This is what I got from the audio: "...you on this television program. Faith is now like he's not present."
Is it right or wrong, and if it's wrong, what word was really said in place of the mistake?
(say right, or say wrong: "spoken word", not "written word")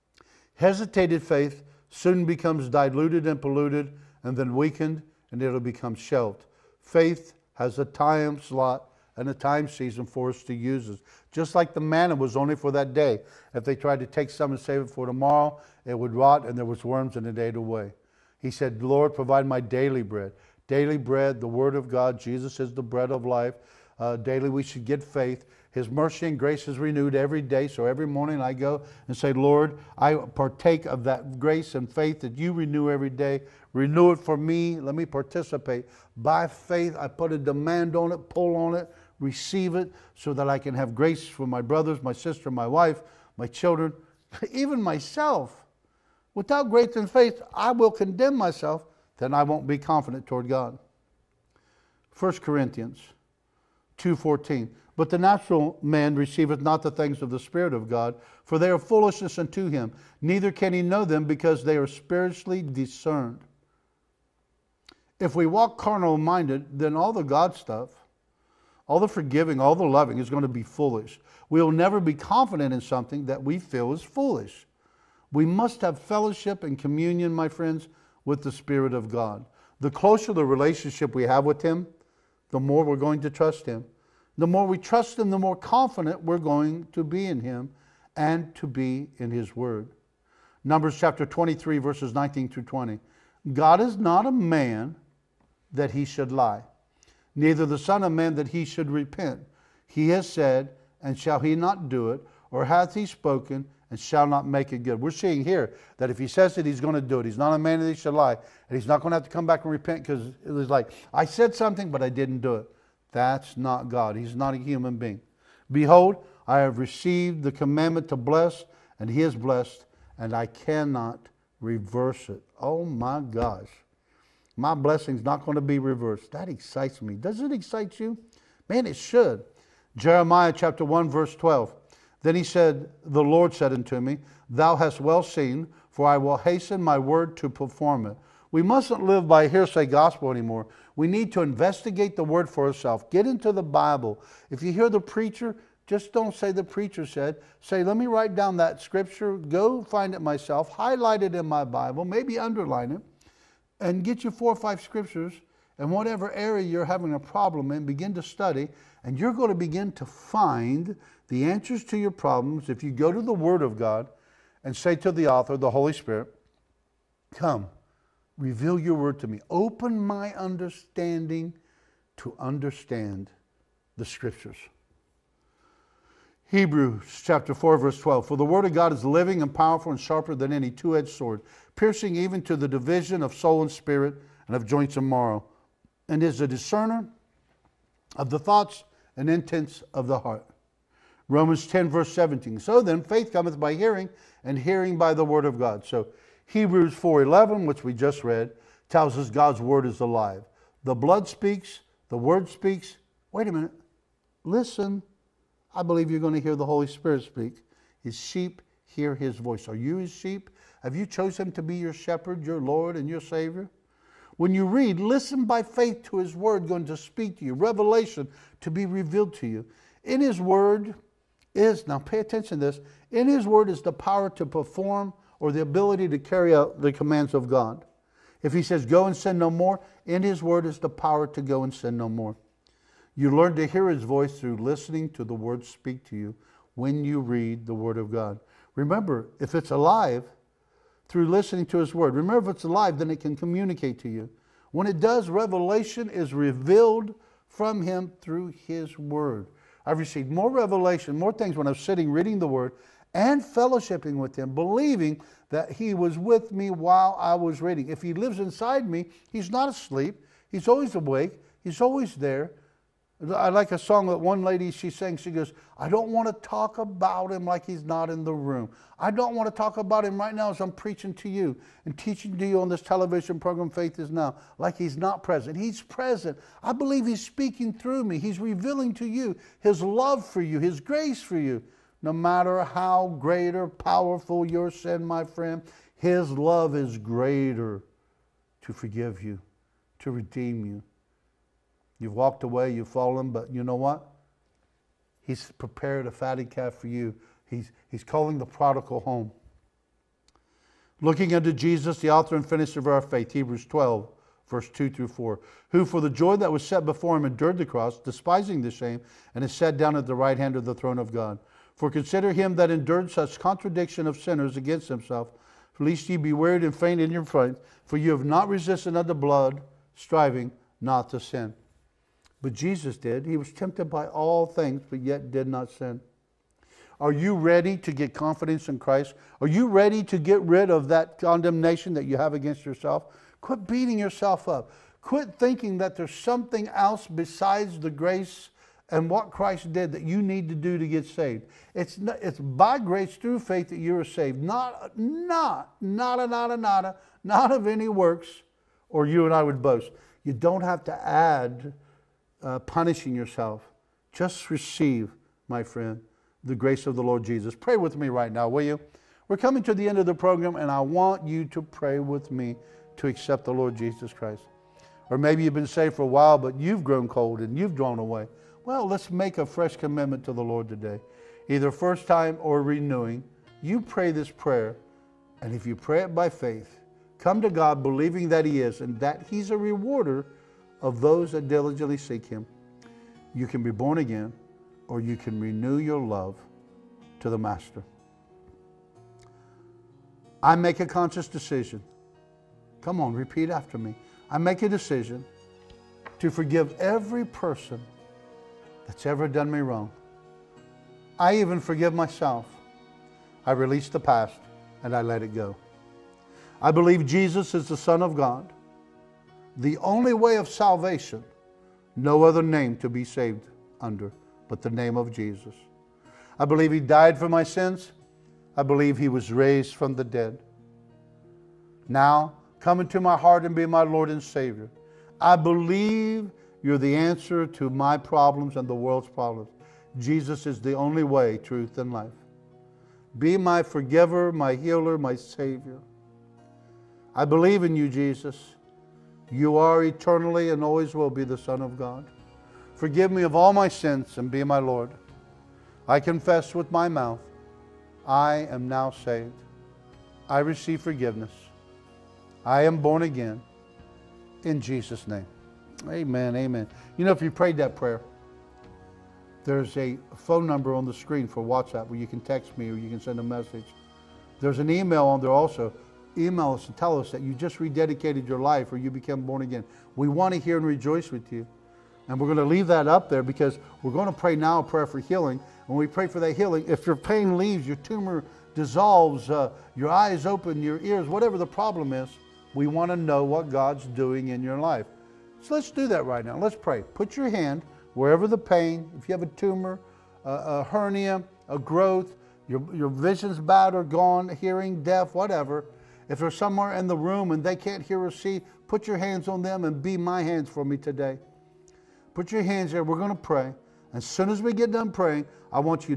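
right.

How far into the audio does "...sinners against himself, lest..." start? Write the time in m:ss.
5:14.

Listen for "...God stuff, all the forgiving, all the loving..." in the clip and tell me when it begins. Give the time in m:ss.
1:07.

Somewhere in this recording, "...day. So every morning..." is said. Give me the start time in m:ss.
0:27.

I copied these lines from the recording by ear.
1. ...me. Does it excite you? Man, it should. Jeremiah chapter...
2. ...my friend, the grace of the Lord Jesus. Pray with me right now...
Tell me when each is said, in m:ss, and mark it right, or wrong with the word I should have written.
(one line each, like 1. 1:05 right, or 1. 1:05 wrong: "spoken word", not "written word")
1. 2:07 right
2. 5:55 right.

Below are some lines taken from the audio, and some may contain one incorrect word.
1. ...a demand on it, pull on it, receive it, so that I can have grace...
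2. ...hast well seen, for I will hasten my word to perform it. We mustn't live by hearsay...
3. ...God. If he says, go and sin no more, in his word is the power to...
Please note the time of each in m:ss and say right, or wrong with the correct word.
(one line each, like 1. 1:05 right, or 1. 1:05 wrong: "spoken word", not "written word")
1. 0:37 right
2. 2:14 right
3. 3:47 right.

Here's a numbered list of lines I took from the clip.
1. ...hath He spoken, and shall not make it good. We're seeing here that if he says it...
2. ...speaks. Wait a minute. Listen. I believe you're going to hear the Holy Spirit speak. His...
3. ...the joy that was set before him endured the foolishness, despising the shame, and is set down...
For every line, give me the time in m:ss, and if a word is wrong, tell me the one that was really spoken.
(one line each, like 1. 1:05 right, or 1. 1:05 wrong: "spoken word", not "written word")
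1. 1:42 right
2. 3:22 right
3. 5:06 wrong: "cross", not "foolishness".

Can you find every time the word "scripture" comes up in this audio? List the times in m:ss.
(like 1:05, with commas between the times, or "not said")
2:28, 2:34, 2:54.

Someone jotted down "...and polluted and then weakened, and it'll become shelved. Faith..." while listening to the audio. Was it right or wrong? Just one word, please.
right.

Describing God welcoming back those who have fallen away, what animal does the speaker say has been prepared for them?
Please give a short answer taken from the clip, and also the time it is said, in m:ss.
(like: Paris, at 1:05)
fatty calf, at 4:56.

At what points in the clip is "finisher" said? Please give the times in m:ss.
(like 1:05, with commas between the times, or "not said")
5:02.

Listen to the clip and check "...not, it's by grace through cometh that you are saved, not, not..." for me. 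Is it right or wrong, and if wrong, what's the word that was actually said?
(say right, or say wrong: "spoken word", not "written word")
wrong: "faith", not "cometh".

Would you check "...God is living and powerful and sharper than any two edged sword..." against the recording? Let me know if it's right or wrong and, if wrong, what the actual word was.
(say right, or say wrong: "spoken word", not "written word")
right.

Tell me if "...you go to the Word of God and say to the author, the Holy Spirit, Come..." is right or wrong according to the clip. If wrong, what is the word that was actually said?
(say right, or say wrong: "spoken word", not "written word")
right.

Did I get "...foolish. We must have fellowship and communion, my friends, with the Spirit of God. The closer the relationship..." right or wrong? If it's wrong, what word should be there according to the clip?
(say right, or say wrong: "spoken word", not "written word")
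right.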